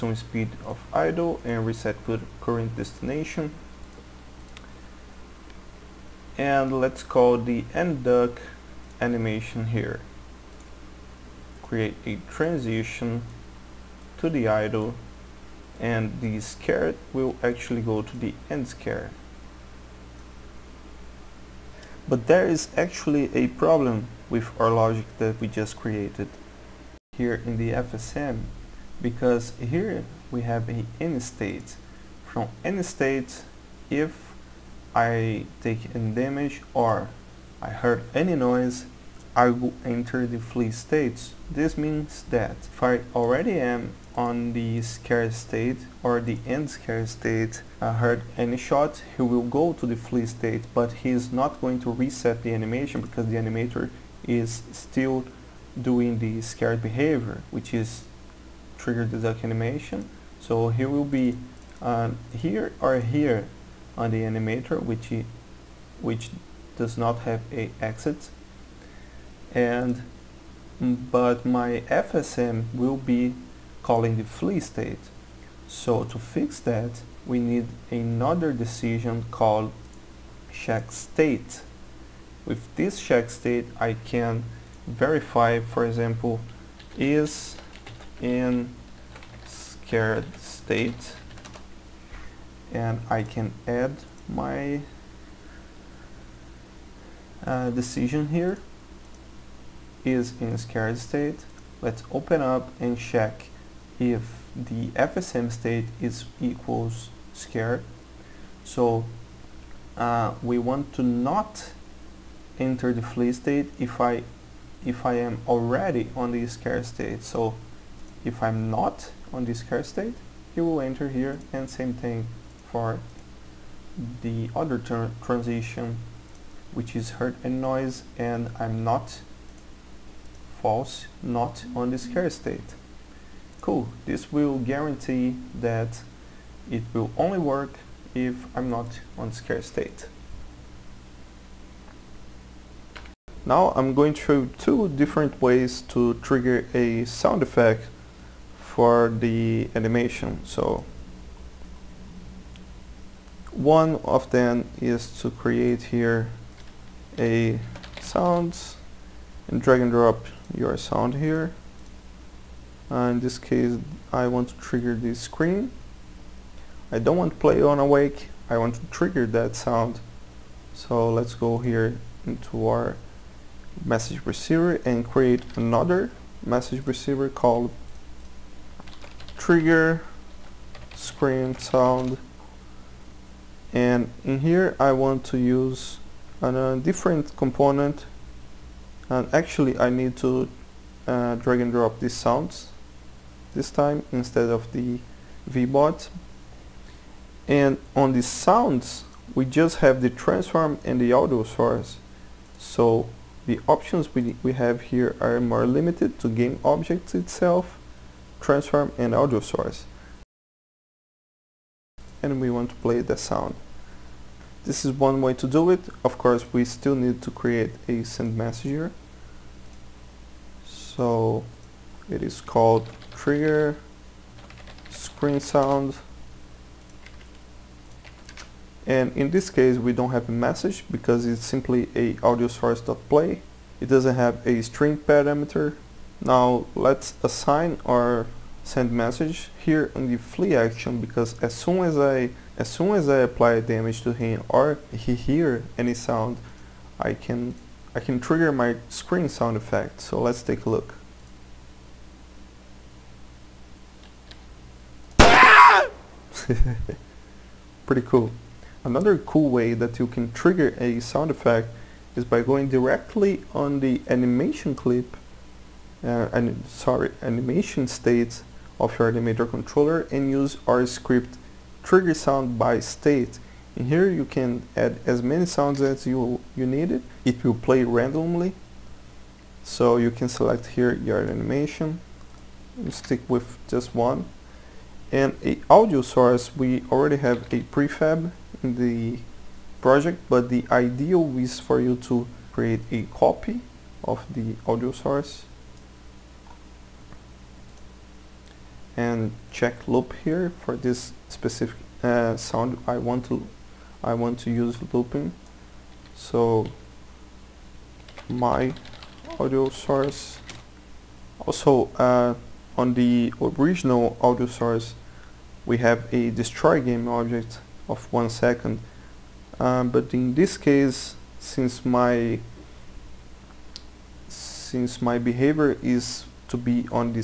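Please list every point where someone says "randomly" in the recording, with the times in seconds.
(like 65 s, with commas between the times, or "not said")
277 s.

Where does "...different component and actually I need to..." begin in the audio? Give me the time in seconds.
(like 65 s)
186 s.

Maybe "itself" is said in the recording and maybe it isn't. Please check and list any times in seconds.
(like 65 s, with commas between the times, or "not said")
207 s.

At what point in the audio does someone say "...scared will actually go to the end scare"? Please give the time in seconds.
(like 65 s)
16 s.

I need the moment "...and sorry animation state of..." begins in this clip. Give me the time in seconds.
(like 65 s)
266 s.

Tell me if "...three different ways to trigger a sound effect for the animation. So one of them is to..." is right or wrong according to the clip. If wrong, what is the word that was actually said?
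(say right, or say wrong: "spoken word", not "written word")
wrong: "two", not "three".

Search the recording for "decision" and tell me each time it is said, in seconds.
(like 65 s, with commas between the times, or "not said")
78 s, 97 s.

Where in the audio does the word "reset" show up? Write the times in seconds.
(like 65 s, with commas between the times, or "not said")
1 s, 51 s.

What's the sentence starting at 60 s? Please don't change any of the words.
So he will be uh, here or here on the animator, which he, which does not have a exit.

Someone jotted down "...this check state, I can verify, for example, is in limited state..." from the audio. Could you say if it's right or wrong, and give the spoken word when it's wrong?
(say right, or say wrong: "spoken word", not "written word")
wrong: "scared", not "limited".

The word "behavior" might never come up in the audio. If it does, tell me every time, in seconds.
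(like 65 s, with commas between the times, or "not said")
56 s, 325 s.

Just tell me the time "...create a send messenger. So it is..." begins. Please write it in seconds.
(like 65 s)
217 s.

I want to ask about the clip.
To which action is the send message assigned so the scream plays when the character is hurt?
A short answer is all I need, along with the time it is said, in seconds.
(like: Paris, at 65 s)
flee action, at 240 s.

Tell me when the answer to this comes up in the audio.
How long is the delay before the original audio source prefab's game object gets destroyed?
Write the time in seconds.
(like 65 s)
318 s.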